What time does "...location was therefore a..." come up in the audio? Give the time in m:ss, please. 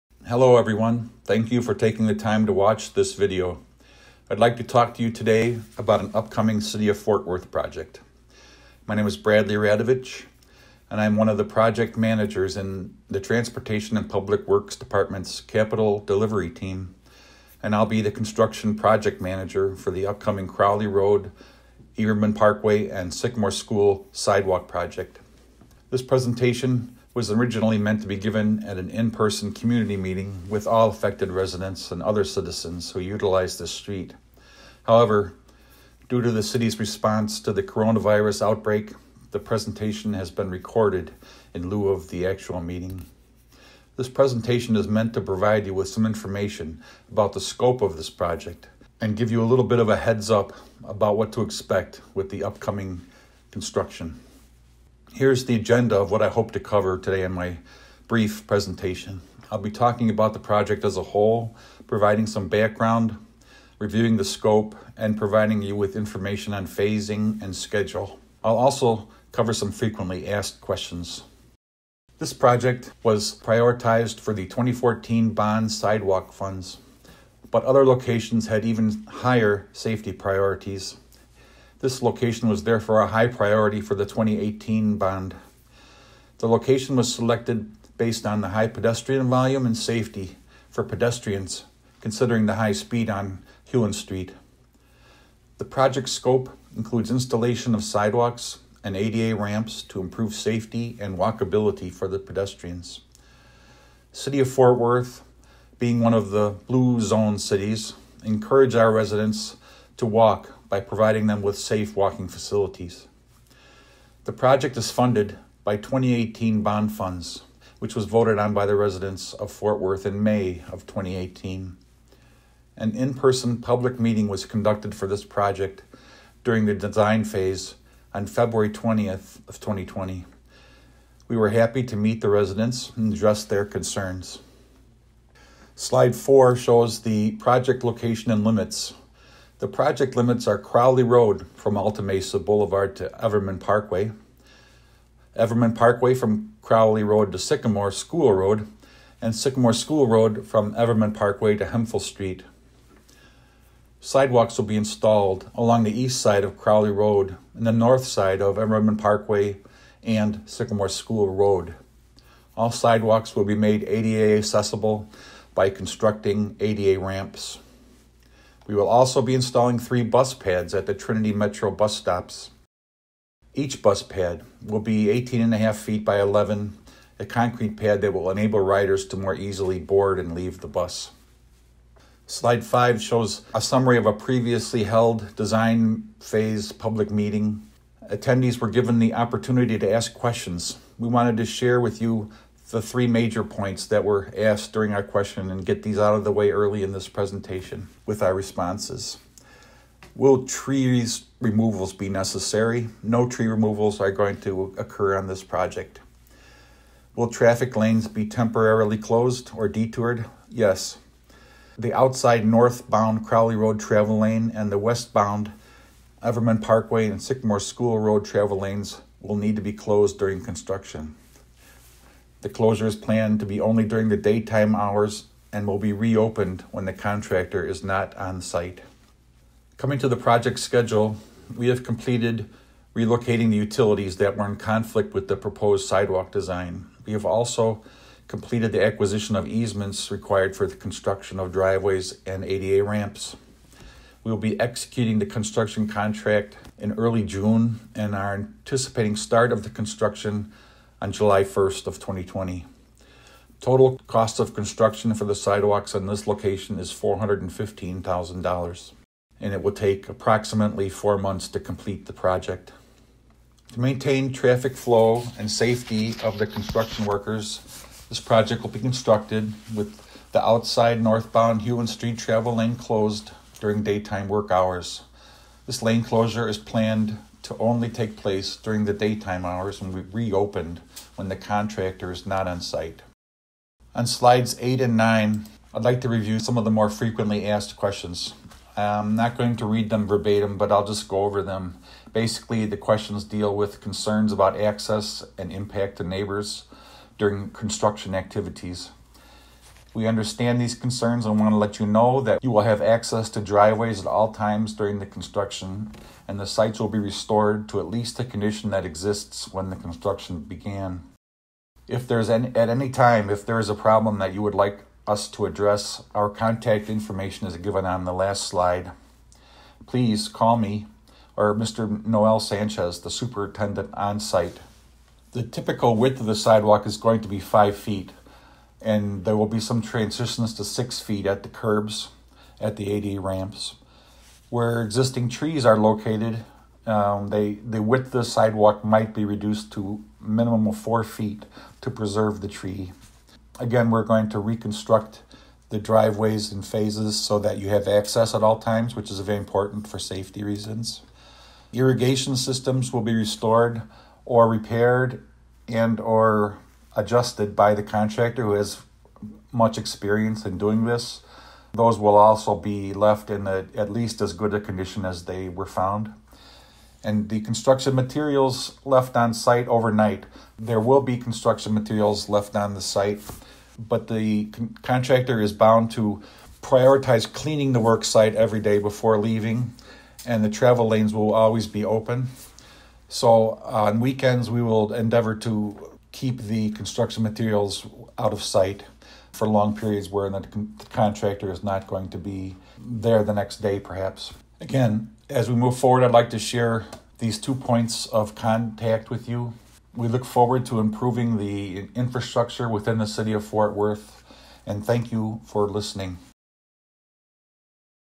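1:22.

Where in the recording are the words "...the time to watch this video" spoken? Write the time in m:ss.
0:02.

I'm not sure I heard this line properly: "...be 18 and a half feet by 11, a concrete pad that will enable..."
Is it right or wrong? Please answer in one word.
right.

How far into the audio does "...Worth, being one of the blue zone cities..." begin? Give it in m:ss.
1:44.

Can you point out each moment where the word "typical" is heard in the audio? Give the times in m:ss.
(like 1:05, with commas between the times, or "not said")
5:25.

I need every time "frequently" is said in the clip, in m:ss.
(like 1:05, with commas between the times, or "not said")
1:09, 4:46.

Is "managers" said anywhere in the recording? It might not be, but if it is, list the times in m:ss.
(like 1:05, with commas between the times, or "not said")
0:11, 0:19.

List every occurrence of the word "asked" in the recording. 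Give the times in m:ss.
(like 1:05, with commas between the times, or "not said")
1:10, 3:14, 4:47.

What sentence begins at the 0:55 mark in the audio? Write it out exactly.
Here's the agenda of what I hope to cover today in my brief presentation.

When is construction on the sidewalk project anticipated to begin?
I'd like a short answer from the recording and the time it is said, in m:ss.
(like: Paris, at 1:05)
July 1, 2020, at 4:11.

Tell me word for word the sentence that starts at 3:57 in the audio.
We have also completed the acquisition of easements required for the construction of driveways and ADA ramps.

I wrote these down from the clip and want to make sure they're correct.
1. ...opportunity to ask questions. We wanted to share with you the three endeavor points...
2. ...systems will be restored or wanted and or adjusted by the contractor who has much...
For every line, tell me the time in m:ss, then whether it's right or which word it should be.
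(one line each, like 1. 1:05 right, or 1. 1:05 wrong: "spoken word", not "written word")
1. 3:09 wrong: "major", not "endeavor"
2. 5:52 wrong: "repaired", not "wanted".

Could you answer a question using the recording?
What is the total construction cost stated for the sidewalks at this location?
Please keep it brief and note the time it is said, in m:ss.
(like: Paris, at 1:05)
$415,000, at 4:16.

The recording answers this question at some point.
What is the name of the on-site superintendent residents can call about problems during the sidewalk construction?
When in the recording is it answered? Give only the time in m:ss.
5:21.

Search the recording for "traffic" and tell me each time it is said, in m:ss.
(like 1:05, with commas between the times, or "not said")
3:27, 4:24.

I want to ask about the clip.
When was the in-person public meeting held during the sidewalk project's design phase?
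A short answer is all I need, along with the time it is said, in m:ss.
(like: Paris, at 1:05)
February 20, 2020, at 2:08.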